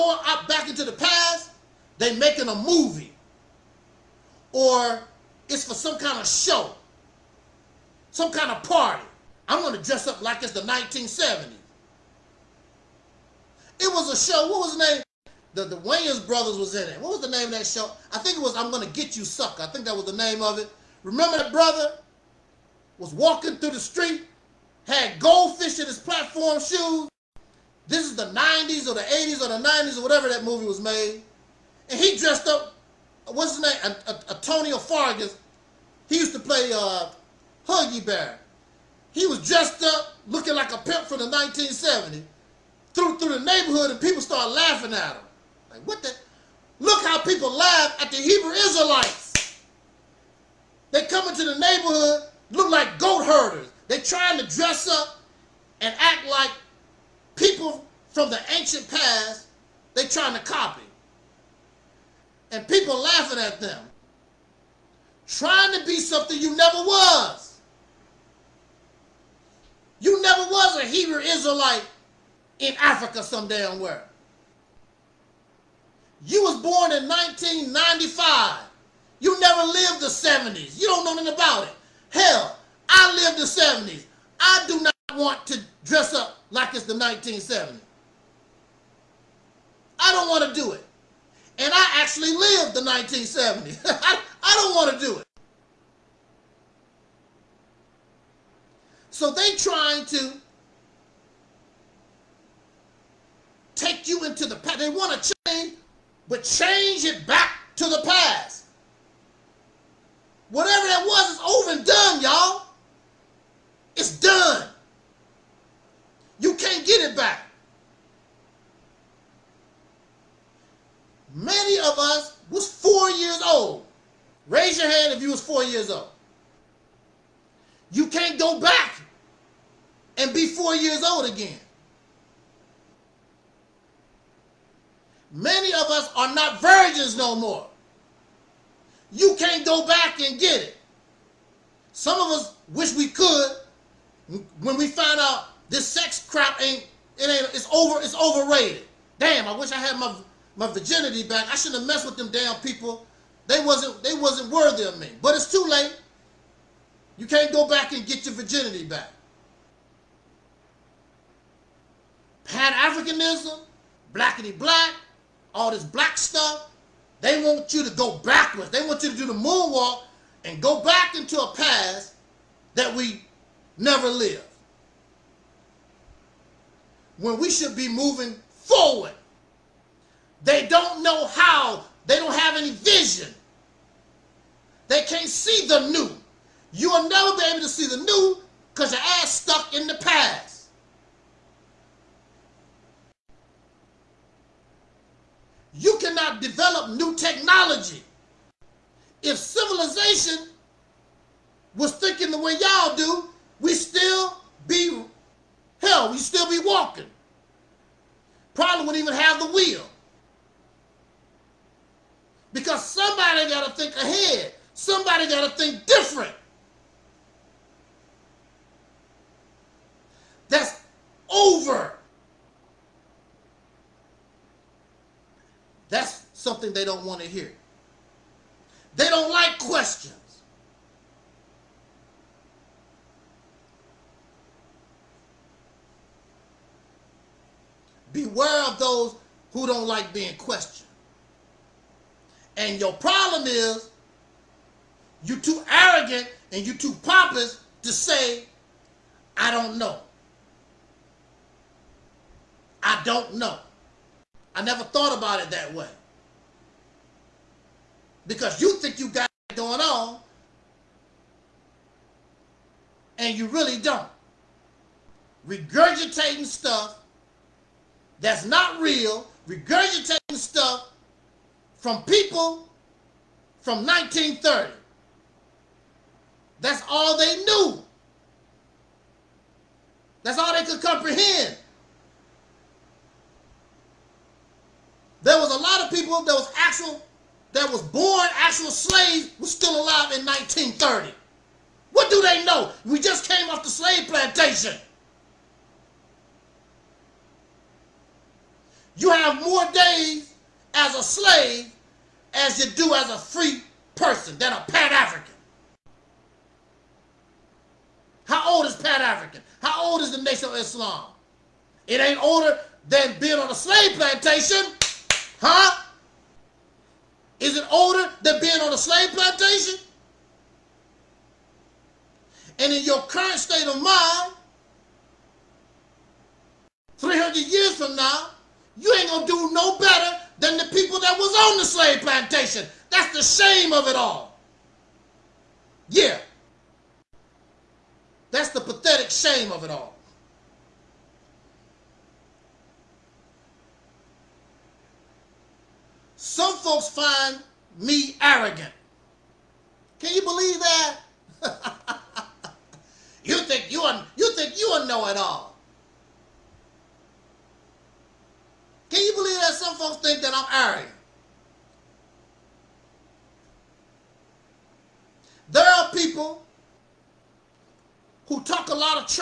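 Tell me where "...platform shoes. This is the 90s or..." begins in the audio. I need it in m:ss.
0:25.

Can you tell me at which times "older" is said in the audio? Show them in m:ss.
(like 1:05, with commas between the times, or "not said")
5:12, 5:17.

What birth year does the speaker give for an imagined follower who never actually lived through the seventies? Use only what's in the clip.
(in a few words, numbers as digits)
1995.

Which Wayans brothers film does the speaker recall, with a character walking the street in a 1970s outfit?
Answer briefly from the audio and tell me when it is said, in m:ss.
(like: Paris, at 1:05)
I'm Gonna Get You Sucker, at 0:18.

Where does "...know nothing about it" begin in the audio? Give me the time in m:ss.
1:21.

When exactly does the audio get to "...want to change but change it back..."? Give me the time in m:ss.
1:44.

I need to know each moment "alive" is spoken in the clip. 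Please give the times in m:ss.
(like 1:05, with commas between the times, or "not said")
4:49.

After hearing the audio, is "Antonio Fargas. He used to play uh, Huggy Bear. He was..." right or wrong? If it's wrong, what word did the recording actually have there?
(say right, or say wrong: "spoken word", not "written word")
right.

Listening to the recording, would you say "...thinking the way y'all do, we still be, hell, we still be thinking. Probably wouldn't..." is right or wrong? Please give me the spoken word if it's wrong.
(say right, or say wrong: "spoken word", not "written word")
wrong: "walking", not "thinking".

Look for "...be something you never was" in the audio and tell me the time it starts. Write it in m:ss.
1:05.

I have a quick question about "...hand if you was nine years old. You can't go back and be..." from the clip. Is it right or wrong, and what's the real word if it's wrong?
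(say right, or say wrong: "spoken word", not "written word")
wrong: "four", not "nine".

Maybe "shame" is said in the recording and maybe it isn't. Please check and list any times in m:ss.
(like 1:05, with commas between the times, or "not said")
5:33, 5:39.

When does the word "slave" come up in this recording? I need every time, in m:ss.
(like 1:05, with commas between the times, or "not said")
4:48, 4:53, 5:01, 5:13, 5:18, 5:31.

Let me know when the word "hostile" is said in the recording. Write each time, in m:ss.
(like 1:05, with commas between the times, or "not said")
not said.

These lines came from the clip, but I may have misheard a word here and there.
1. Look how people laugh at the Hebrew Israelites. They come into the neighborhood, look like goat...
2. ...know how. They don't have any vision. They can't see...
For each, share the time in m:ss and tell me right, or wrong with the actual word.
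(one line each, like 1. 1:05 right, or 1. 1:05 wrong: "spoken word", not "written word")
1. 0:46 right
2. 3:01 right.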